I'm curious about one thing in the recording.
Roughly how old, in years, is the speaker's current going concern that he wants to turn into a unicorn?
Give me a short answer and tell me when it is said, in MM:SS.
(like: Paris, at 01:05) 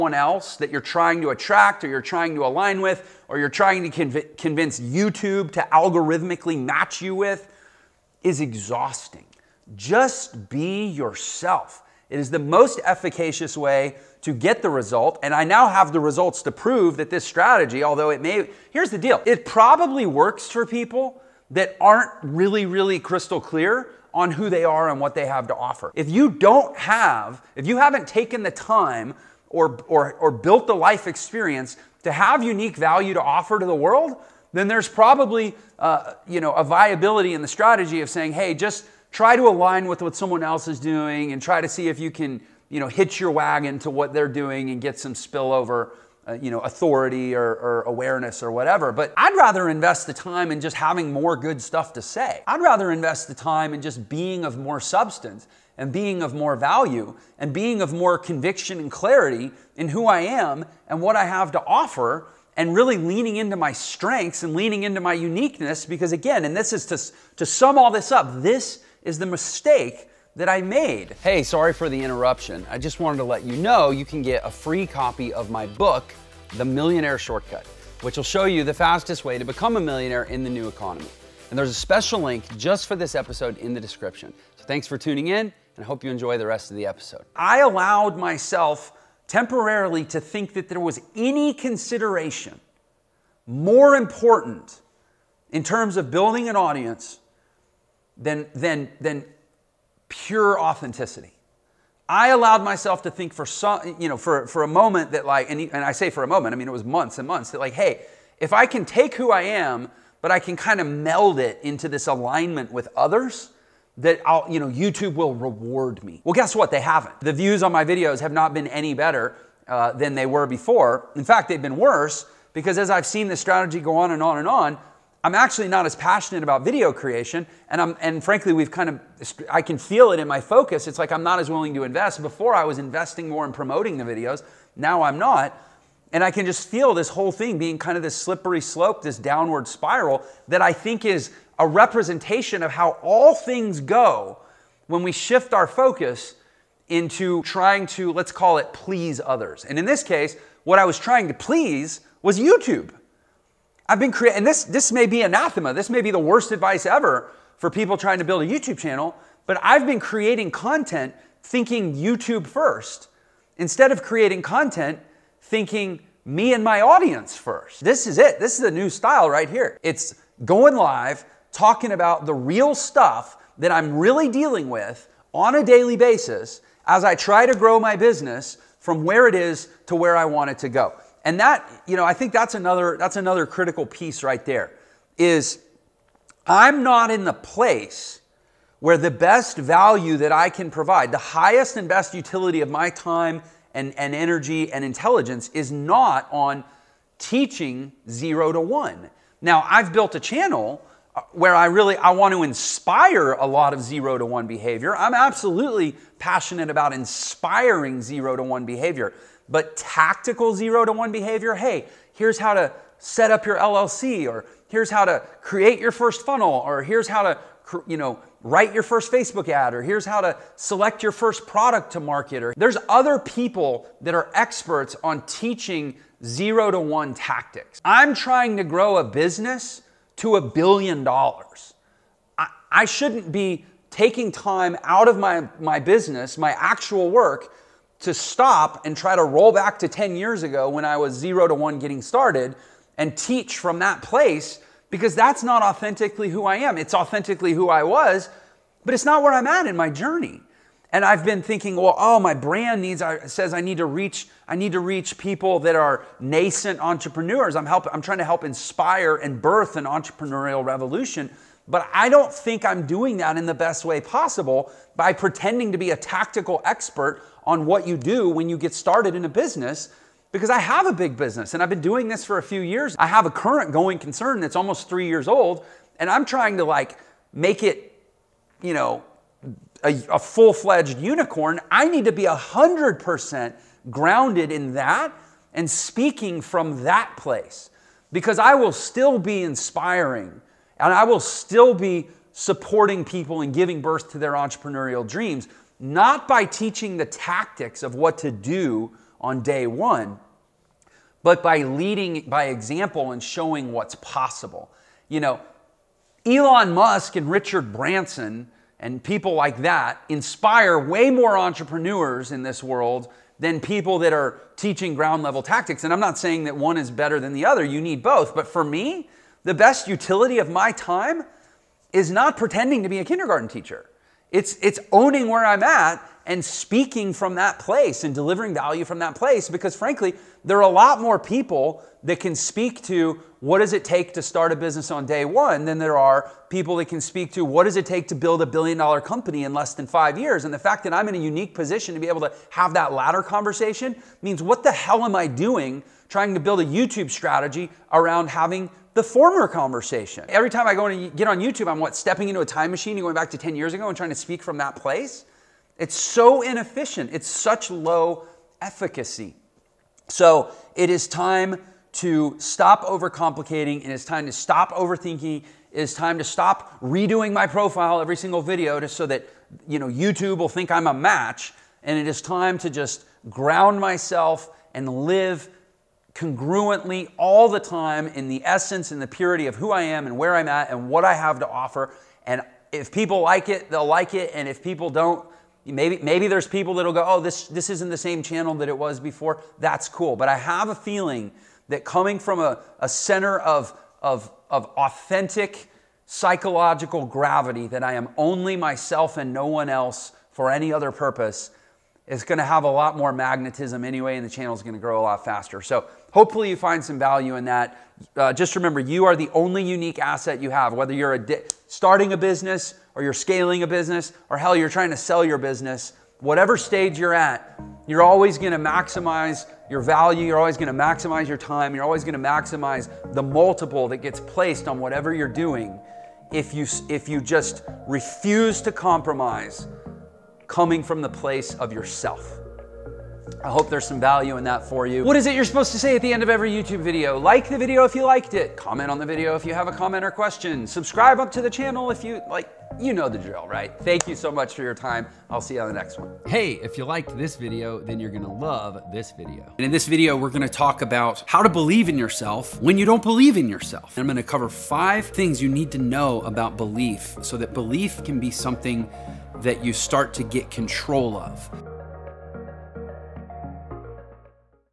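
almost 3 years, at 04:34.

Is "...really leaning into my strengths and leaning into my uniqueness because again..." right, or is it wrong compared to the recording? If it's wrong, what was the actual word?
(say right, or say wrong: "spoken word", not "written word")
right.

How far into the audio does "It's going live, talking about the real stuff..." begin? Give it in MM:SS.
02:49.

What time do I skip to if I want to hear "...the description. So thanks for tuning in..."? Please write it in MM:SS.
01:23.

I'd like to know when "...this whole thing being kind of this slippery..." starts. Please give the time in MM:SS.
02:16.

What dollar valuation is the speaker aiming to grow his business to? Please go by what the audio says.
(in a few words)
a billion dollars.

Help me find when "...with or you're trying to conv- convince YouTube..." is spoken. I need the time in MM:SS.
00:02.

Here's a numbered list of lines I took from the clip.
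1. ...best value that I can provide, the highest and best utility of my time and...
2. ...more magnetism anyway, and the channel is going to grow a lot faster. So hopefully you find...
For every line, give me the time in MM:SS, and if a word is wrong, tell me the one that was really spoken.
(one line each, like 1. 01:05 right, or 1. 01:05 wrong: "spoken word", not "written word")
1. 03:09 right
2. 06:42 right.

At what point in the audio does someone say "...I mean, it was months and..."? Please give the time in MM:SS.
01:46.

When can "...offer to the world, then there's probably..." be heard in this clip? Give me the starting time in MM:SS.
00:33.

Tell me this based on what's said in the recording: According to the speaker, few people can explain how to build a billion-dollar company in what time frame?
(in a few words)
less than 5 years.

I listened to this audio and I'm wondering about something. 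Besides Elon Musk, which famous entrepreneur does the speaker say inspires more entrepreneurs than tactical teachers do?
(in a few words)
Richard Branson.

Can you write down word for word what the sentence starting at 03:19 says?
Now, I've built a channel uh, where I really I want to inspire a lot of zero to one behavior.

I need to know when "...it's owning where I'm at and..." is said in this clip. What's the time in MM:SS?
05:24.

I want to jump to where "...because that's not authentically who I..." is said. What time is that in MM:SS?
04:04.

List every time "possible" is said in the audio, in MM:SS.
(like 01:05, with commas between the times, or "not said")
04:24, 05:03.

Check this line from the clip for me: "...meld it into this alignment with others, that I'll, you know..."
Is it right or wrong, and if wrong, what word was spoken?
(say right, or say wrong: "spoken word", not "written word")
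right.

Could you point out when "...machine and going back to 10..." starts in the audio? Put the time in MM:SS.
05:52.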